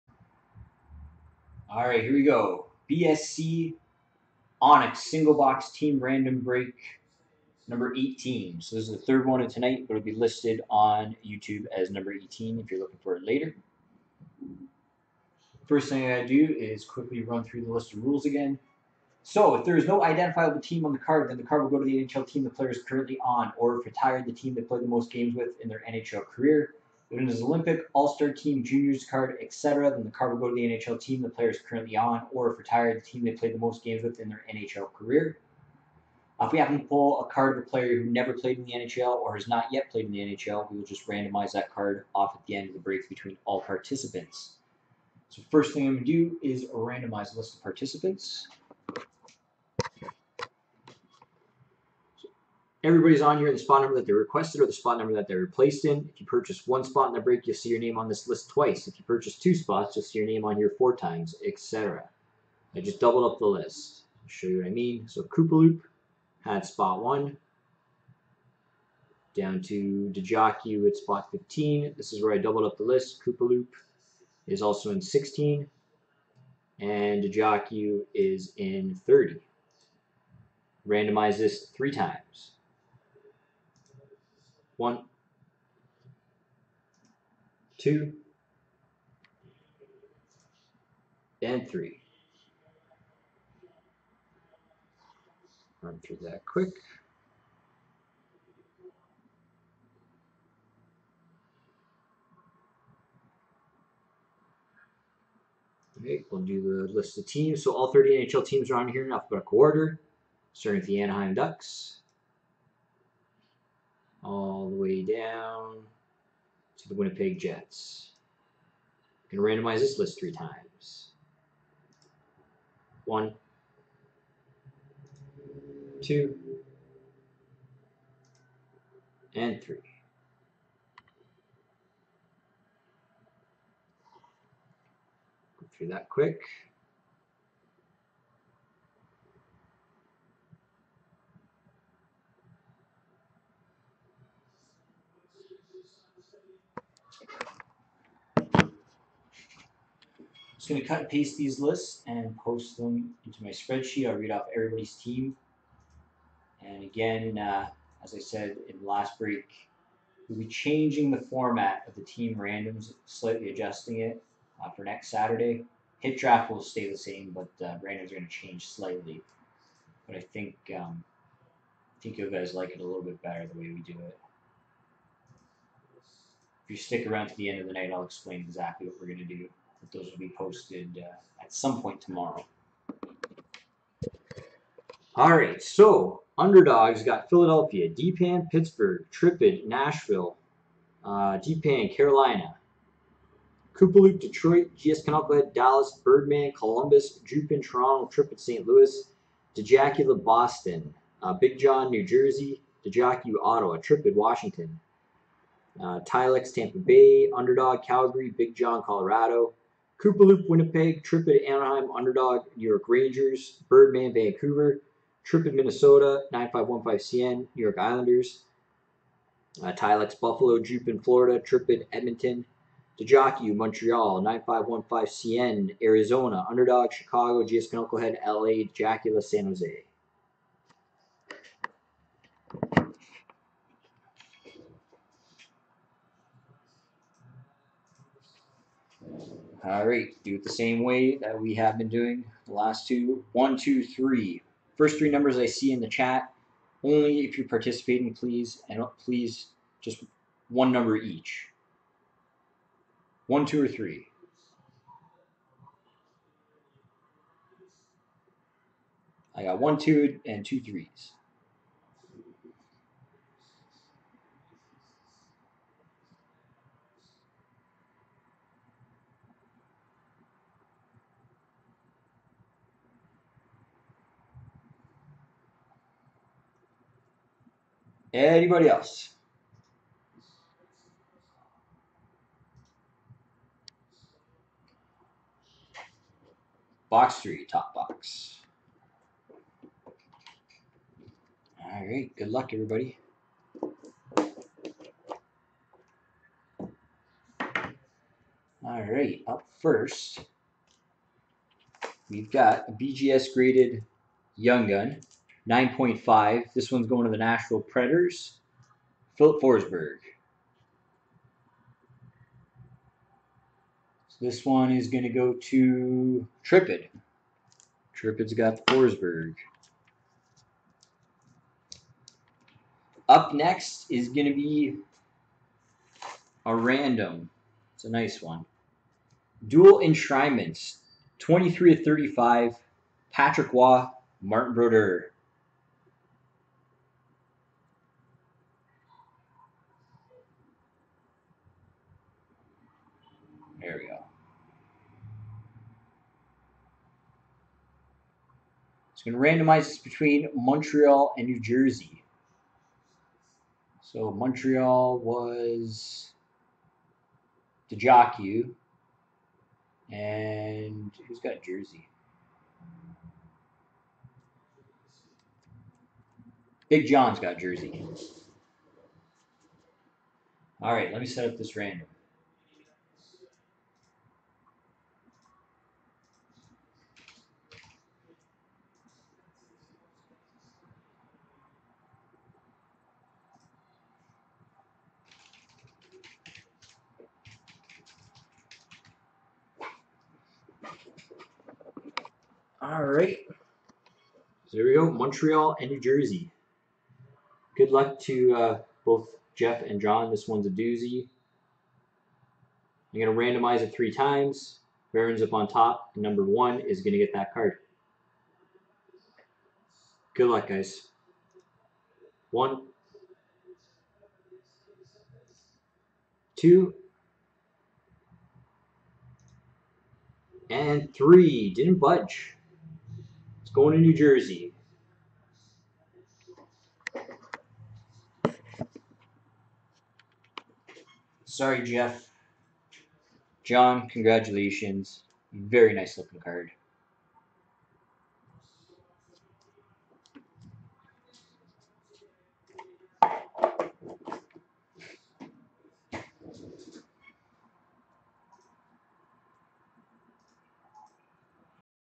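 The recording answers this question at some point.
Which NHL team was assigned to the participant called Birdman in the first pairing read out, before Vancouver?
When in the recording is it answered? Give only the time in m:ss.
3:16.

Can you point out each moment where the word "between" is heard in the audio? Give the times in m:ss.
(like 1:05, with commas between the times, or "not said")
0:43, 5:49.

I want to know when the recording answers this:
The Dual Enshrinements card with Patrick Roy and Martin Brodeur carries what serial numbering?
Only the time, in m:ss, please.
5:31.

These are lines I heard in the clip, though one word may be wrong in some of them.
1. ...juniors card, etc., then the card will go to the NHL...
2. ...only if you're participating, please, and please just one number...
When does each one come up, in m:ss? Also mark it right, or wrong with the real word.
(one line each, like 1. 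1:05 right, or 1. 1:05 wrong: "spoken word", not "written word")
1. 0:28 right
2. 4:06 right.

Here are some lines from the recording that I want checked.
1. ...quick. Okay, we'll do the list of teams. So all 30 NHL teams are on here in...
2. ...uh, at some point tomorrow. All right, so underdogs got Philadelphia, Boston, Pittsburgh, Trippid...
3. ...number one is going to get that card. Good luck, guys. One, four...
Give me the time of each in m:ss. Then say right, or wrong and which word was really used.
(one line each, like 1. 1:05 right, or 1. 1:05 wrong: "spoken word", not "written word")
1. 1:36 right
2. 3:01 wrong: "DPAN", not "Boston"
3. 6:45 wrong: "two", not "four".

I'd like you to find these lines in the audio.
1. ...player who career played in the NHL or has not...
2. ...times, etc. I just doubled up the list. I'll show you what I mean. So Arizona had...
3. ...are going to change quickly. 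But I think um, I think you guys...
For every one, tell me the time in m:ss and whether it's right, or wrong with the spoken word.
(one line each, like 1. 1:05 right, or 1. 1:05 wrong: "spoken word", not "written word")
1. 0:37 wrong: "never", not "career"
2. 1:00 wrong: "Koopaloop", not "Arizona"
3. 2:48 wrong: "slightly", not "quickly".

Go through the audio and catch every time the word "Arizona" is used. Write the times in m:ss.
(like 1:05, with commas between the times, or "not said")
3:45.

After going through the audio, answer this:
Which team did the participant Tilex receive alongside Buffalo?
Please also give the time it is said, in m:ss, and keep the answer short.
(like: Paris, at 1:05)
Tampa Bay, at 3:26.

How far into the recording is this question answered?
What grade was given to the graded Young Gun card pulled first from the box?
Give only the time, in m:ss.
5:05.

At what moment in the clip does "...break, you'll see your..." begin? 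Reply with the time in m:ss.
0:57.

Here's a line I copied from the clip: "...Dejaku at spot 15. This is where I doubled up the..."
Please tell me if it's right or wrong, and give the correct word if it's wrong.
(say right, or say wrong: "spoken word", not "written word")
right.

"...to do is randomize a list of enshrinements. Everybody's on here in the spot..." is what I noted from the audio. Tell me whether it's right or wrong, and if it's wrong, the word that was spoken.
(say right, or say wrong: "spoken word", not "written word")
wrong: "participants", not "enshrinements".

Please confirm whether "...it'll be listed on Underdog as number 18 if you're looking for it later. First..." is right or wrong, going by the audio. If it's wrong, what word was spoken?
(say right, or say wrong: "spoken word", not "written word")
wrong: "YouTube", not "Underdog".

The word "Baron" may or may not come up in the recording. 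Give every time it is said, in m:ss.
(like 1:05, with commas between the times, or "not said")
6:44.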